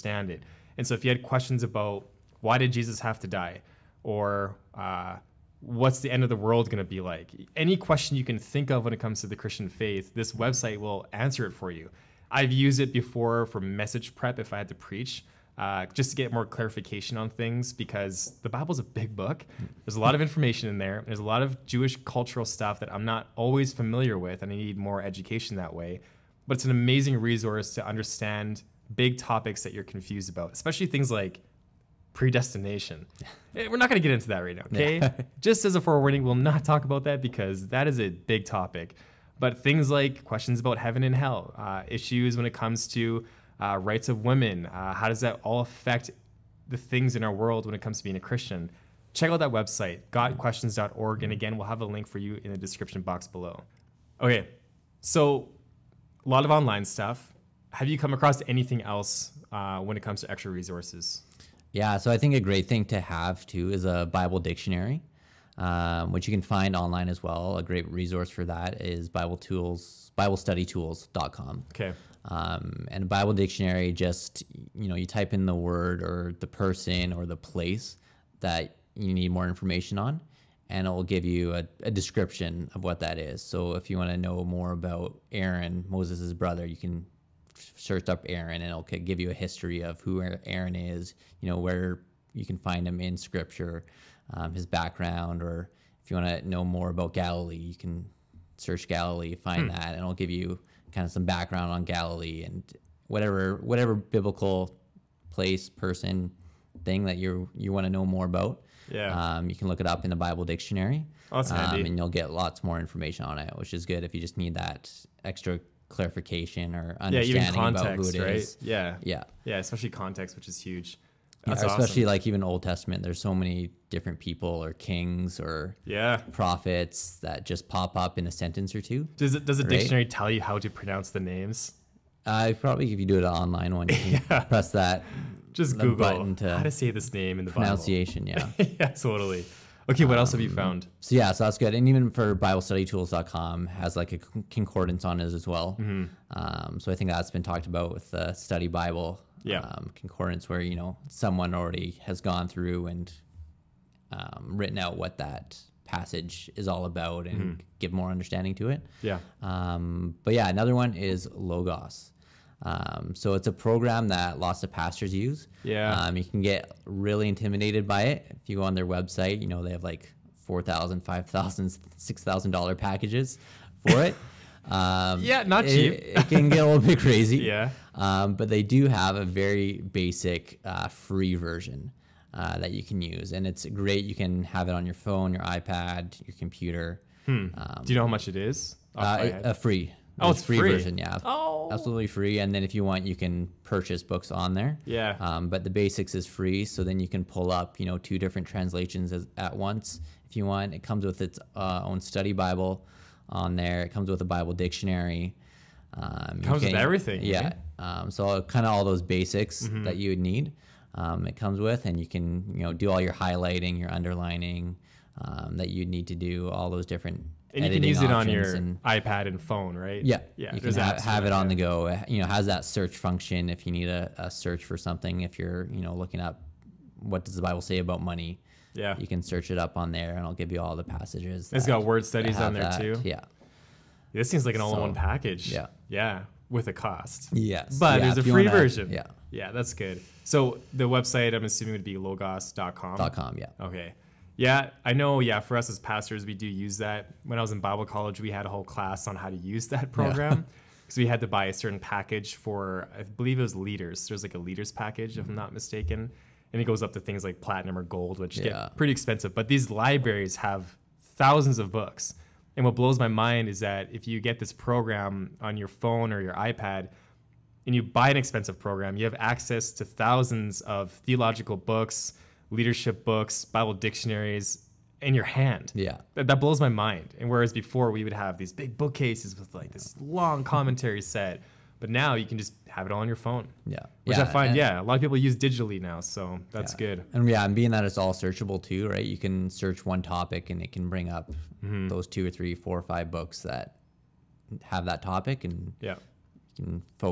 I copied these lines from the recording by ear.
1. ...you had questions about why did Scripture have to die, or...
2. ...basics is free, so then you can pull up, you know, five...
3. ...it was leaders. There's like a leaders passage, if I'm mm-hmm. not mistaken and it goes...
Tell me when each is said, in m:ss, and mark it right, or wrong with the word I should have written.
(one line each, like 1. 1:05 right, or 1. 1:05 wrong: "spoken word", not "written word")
1. 0:01 wrong: "Jesus", not "Scripture"
2. 3:15 wrong: "two", not "five"
3. 4:13 wrong: "package", not "passage".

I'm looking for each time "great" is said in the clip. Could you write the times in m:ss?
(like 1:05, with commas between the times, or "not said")
1:02, 1:07, 3:03.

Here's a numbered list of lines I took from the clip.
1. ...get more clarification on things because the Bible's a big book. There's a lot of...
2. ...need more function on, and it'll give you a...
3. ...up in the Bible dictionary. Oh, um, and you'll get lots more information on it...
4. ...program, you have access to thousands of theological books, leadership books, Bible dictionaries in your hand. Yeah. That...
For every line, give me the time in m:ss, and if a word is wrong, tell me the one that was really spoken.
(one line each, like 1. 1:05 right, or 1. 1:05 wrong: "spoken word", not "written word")
1. 0:16 right
2. 1:19 wrong: "information", not "function"
3. 1:49 right
4. 4:28 right.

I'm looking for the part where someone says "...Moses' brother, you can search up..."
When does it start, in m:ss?
1:25.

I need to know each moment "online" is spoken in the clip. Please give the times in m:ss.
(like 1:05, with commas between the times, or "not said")
0:56, 1:06, 2:13.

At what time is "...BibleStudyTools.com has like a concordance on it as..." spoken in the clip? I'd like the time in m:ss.
2:22.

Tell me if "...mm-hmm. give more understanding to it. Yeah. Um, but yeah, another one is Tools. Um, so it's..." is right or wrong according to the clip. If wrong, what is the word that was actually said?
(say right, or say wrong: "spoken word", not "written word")
wrong: "Logos", not "Tools".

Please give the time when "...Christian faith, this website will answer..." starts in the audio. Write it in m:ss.
0:09.